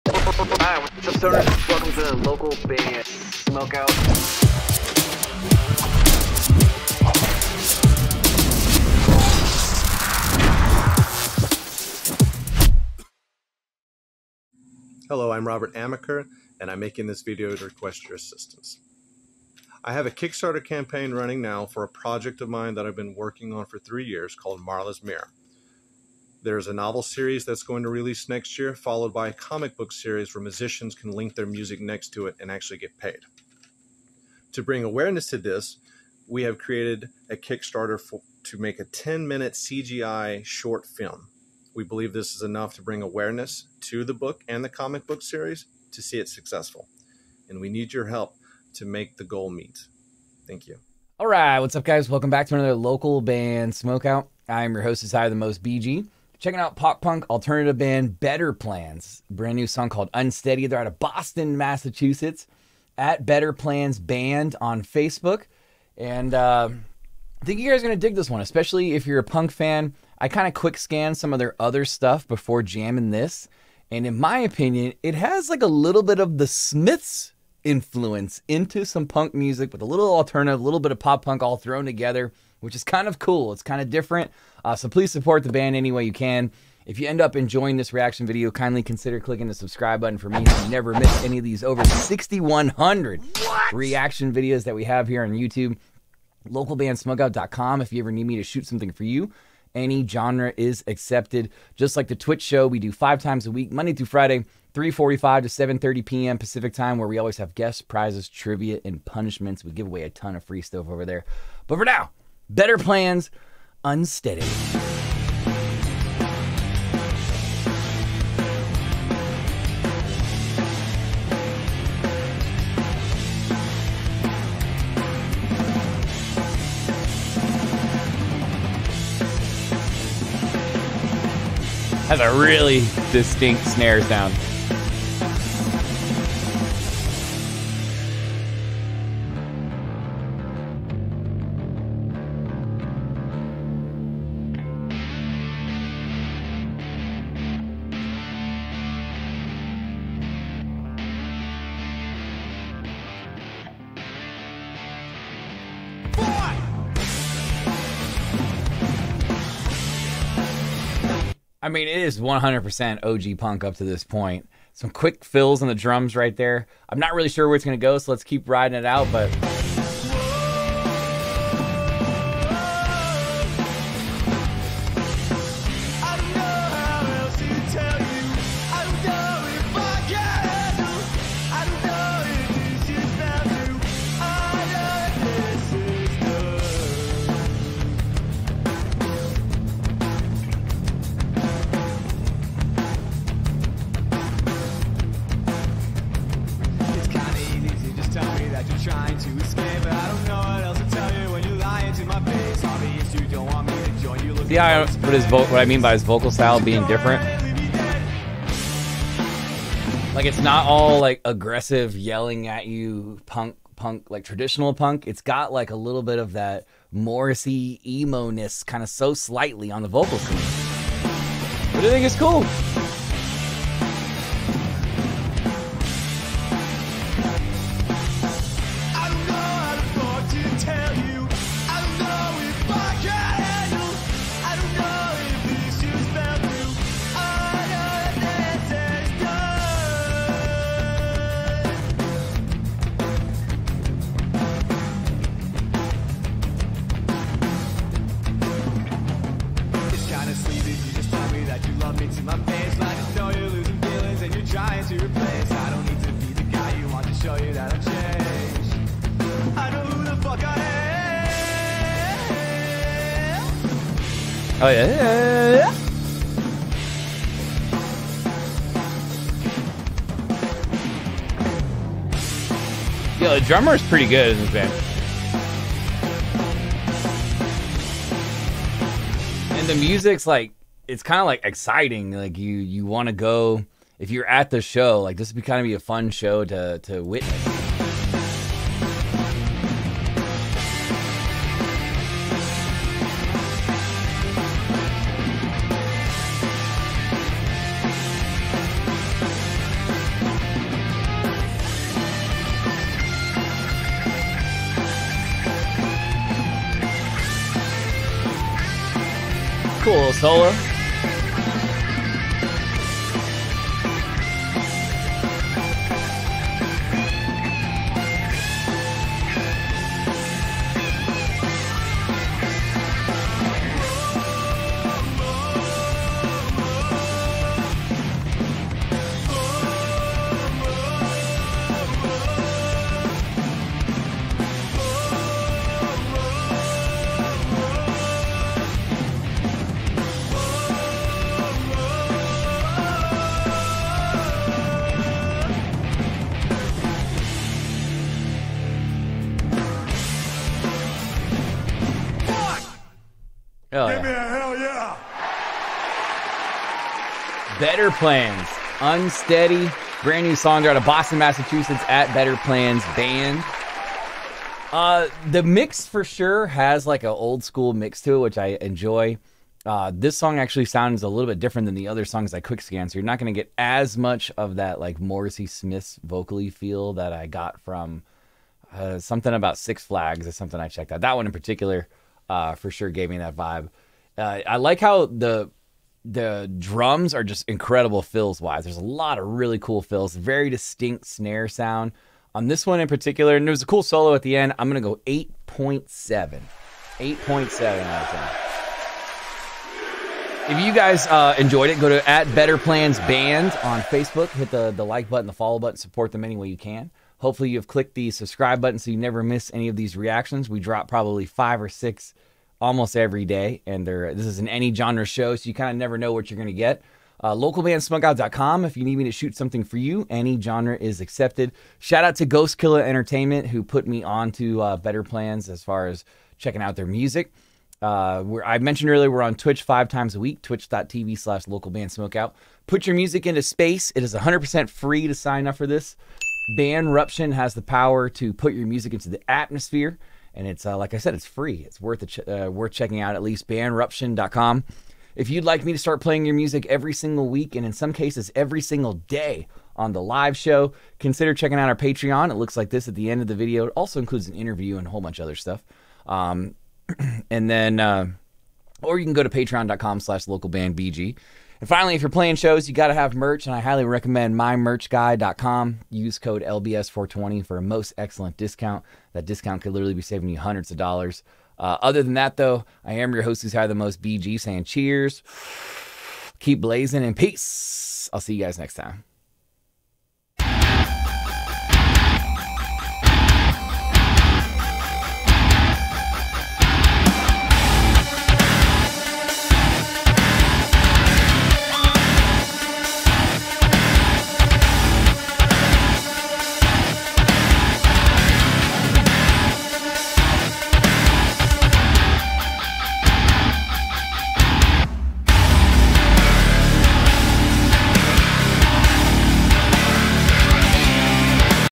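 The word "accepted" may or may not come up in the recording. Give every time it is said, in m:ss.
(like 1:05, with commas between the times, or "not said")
1:40, 7:00.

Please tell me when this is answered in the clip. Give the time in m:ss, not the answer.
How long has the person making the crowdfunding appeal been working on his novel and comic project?
0:23.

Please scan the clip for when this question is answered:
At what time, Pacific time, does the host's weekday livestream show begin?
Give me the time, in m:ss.
1:44.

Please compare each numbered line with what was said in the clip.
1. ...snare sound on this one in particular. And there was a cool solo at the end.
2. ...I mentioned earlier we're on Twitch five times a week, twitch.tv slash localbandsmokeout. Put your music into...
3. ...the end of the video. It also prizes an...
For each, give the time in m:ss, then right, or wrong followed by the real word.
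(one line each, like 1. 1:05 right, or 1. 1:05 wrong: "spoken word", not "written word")
1. 6:31 right
2. 7:08 right
3. 7:32 wrong: "includes", not "prizes".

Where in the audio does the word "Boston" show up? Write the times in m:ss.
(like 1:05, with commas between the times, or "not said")
1:00, 6:00.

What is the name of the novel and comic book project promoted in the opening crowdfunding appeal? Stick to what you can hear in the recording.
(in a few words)
Marla's Mirror.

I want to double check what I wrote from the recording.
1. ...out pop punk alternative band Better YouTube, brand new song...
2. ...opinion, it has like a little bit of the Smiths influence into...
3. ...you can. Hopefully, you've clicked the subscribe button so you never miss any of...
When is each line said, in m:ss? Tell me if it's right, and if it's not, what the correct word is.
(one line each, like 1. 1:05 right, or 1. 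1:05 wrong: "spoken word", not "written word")
1. 0:56 wrong: "Plans", not "YouTube"
2. 1:14 right
3. 6:46 right.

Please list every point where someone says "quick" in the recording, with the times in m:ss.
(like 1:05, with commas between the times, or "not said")
1:10, 2:44, 6:12.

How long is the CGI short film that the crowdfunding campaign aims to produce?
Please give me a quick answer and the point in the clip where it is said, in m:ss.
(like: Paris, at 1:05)
10 minutes, at 0:38.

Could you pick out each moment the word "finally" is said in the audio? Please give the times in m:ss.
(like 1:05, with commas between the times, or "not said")
7:41.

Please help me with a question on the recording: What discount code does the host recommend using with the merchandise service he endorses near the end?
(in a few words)
LBS420.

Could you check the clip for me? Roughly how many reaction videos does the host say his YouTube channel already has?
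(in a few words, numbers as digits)
over 6,100.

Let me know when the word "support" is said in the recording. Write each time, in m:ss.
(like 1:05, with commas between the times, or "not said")
1:25, 6:45.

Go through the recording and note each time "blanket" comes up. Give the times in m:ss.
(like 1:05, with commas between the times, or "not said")
not said.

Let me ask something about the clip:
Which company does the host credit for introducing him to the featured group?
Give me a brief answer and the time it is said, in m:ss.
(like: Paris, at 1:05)
Ghost Killer Entertainment, at 7:02.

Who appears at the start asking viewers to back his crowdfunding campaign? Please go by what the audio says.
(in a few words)
Robert Amaker.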